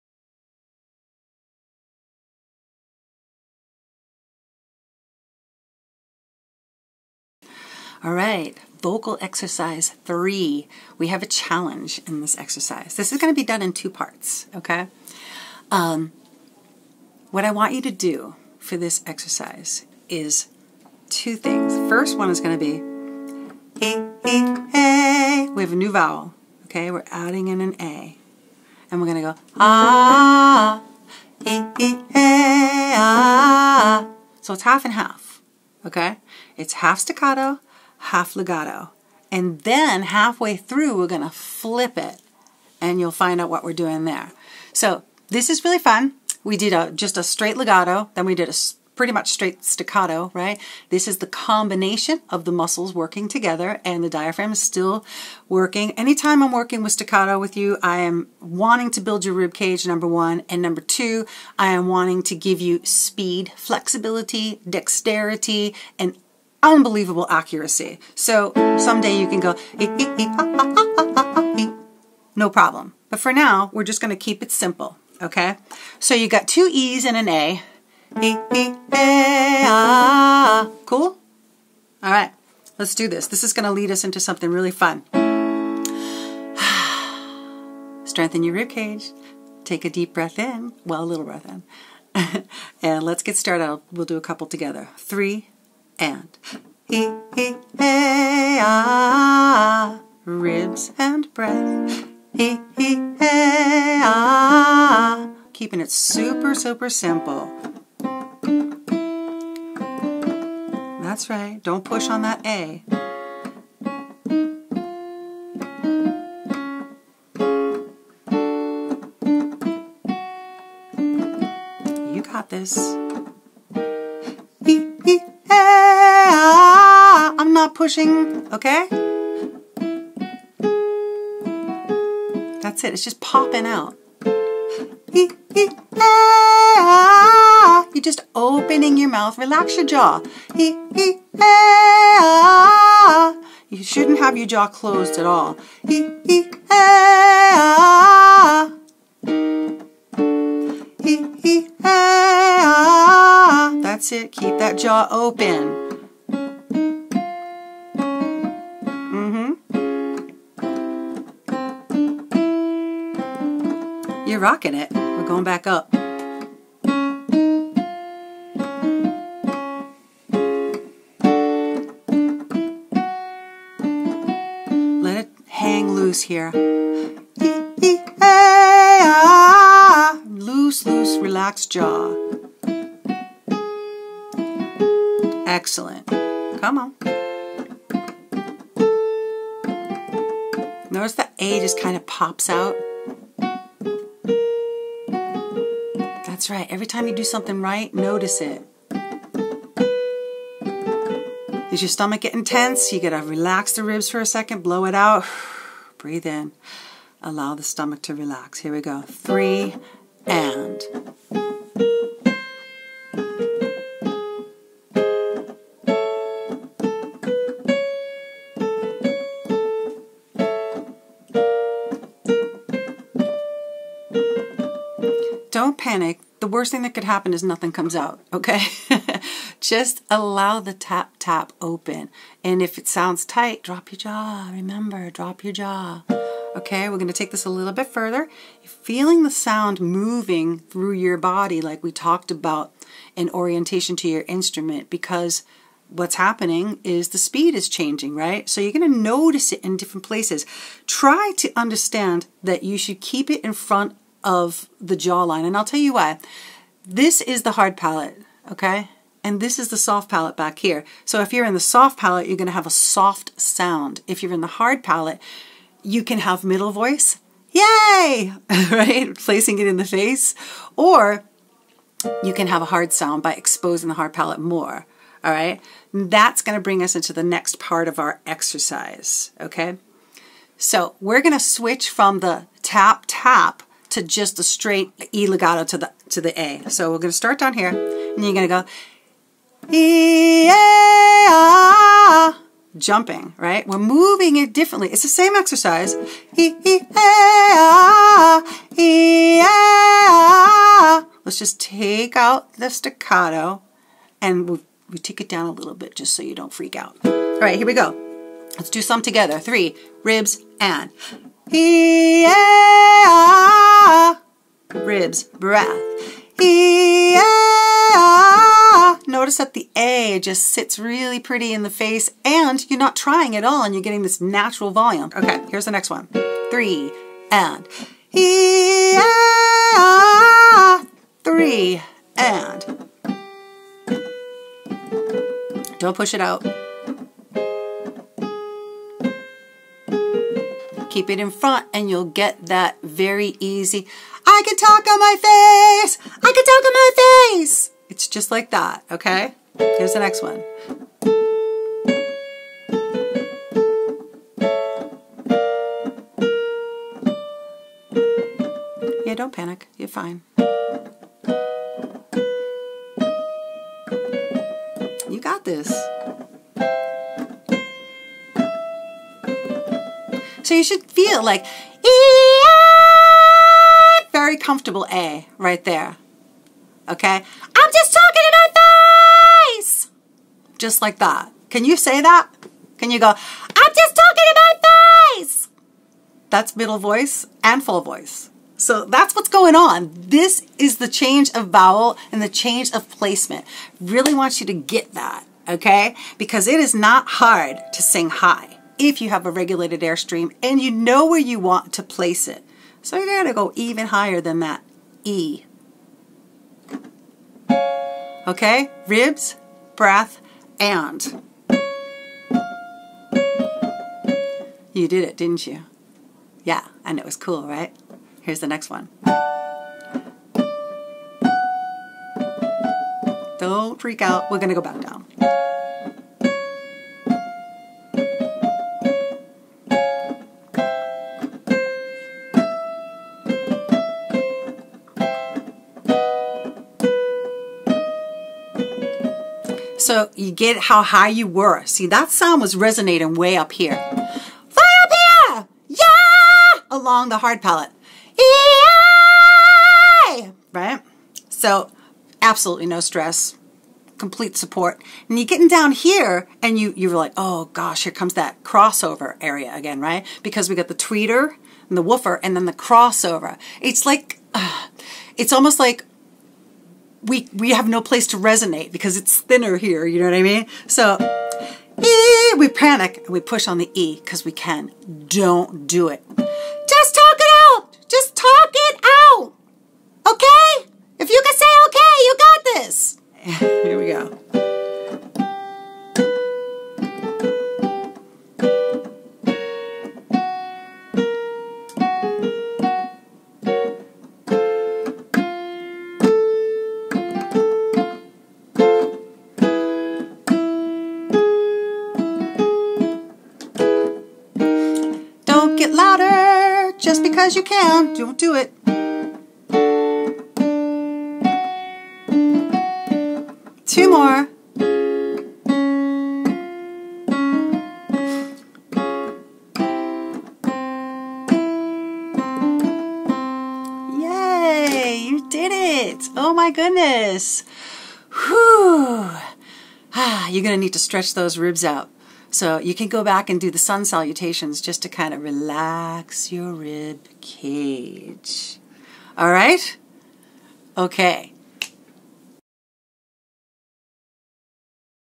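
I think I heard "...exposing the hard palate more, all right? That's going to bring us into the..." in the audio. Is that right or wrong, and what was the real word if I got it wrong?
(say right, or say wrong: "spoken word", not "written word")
right.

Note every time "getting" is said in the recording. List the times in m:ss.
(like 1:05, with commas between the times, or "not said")
3:22, 5:23, 7:35.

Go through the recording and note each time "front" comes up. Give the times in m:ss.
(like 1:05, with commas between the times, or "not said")
4:13, 5:41.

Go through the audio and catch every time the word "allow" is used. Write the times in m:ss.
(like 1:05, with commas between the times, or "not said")
3:27, 3:50.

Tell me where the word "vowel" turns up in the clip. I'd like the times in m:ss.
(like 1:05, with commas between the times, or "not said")
0:25, 6:31.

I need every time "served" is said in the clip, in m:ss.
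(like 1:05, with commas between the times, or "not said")
not said.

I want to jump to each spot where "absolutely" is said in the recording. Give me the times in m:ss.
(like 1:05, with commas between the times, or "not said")
7:32.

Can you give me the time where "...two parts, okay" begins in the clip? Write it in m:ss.
0:13.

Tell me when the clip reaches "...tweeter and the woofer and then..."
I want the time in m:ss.
7:40.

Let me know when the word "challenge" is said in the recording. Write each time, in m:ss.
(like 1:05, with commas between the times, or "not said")
0:11.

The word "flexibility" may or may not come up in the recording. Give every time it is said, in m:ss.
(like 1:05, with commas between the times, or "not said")
1:03.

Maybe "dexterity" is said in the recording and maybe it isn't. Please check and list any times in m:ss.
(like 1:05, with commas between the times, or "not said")
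1:04.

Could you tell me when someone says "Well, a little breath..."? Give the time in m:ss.
1:30.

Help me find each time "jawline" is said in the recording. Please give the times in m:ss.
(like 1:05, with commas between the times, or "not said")
4:14.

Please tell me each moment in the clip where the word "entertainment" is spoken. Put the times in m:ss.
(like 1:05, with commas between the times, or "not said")
not said.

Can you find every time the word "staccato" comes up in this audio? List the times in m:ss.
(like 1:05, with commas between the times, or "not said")
0:36, 0:49, 0:56, 5:02.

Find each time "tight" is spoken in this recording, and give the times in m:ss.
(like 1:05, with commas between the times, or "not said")
3:53.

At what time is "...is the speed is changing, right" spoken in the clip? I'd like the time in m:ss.
4:06.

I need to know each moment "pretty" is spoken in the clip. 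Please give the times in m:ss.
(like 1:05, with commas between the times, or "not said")
0:48, 5:21.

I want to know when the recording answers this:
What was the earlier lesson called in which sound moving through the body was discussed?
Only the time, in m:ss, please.
4:03.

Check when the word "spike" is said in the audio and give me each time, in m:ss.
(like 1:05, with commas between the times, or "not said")
not said.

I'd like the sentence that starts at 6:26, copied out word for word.
That's middle voice and full voice.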